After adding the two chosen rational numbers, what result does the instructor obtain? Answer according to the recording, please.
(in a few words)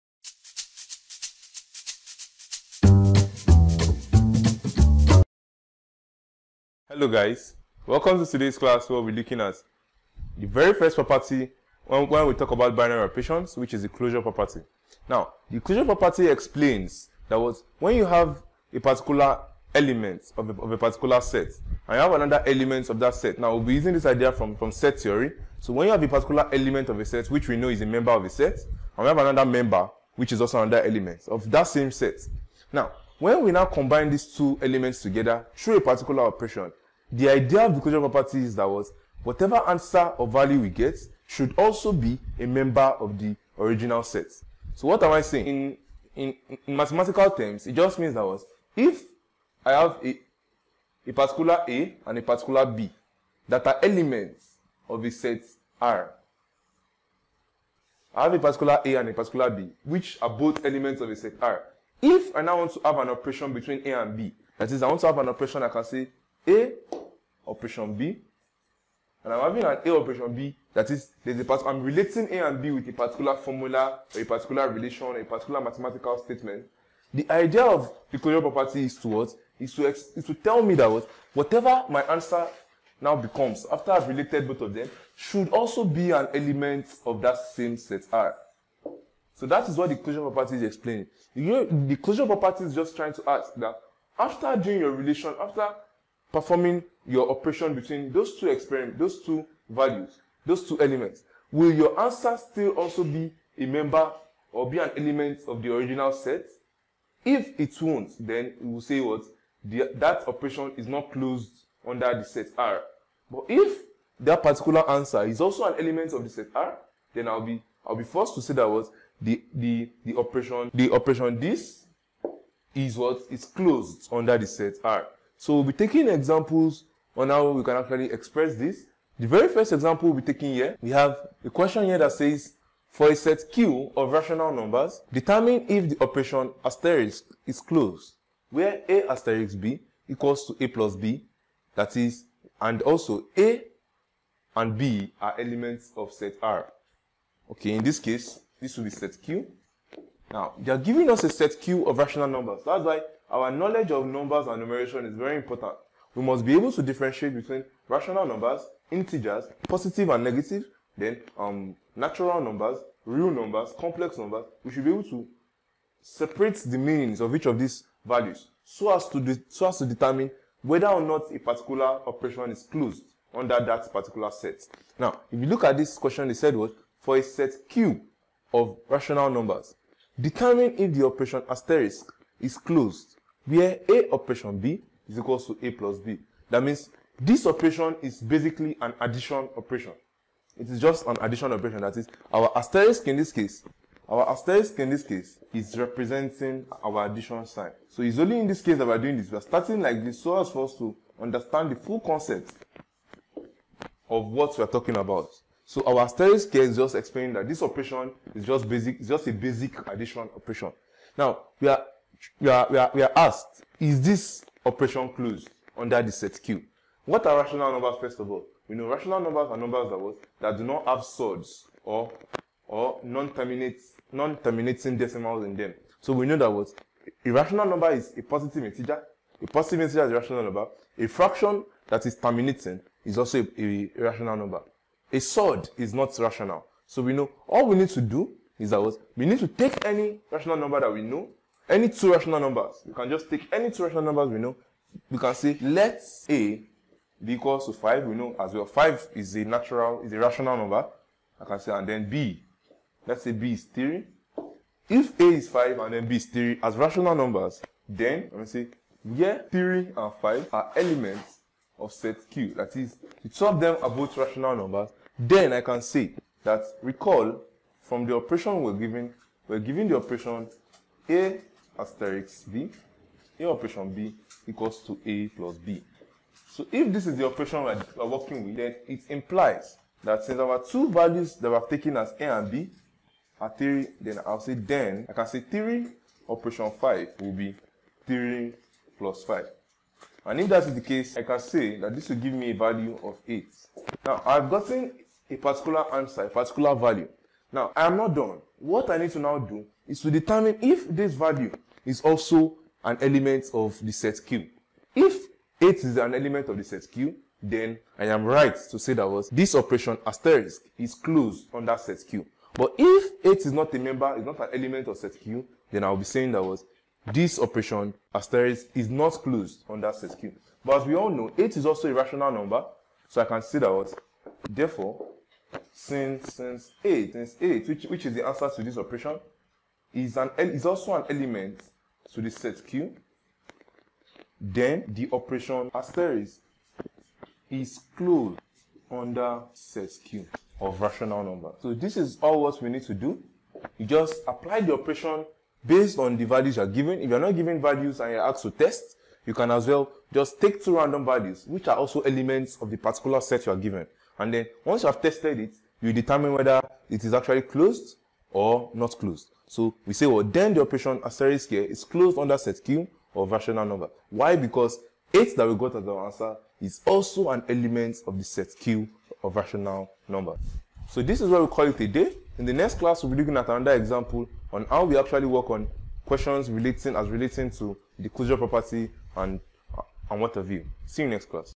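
8.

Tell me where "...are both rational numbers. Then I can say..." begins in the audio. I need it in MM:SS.
04:23.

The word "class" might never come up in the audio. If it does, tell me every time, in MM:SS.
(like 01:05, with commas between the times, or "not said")
00:08, 06:12, 06:21.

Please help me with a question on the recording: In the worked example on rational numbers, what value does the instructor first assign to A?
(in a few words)
5.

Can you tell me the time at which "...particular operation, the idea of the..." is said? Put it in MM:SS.
00:35.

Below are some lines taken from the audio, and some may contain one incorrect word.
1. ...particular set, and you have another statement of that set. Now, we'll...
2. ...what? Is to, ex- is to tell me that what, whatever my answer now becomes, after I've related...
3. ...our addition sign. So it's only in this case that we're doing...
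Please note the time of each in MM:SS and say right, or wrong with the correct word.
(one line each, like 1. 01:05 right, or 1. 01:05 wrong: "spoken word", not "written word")
1. 00:20 wrong: "element", not "statement"
2. 01:19 right
3. 03:16 right.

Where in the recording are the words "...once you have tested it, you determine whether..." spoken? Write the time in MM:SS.
05:54.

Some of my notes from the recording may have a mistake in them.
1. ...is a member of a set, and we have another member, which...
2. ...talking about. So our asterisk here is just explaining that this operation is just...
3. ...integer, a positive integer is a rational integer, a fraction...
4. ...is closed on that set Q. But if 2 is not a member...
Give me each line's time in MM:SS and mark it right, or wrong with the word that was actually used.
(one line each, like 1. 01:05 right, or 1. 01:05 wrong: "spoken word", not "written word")
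1. 00:27 right
2. 03:24 right
3. 03:48 wrong: "number", not "integer"
4. 05:10 wrong: "8", not "2".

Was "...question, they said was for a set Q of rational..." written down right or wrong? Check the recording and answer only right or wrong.
right.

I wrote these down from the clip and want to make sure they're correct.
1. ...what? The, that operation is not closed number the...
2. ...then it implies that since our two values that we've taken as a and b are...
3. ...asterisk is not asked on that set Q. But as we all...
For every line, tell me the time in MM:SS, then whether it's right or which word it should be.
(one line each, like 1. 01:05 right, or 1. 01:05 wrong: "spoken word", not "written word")
1. 01:49 wrong: "under", not "number"
2. 04:38 right
3. 05:18 wrong: "closed", not "asked".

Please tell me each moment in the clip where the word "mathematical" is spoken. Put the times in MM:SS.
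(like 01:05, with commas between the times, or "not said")
00:46, 01:15.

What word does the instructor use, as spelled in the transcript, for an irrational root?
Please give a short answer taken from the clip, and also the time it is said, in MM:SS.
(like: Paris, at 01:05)
sword, at 03:55.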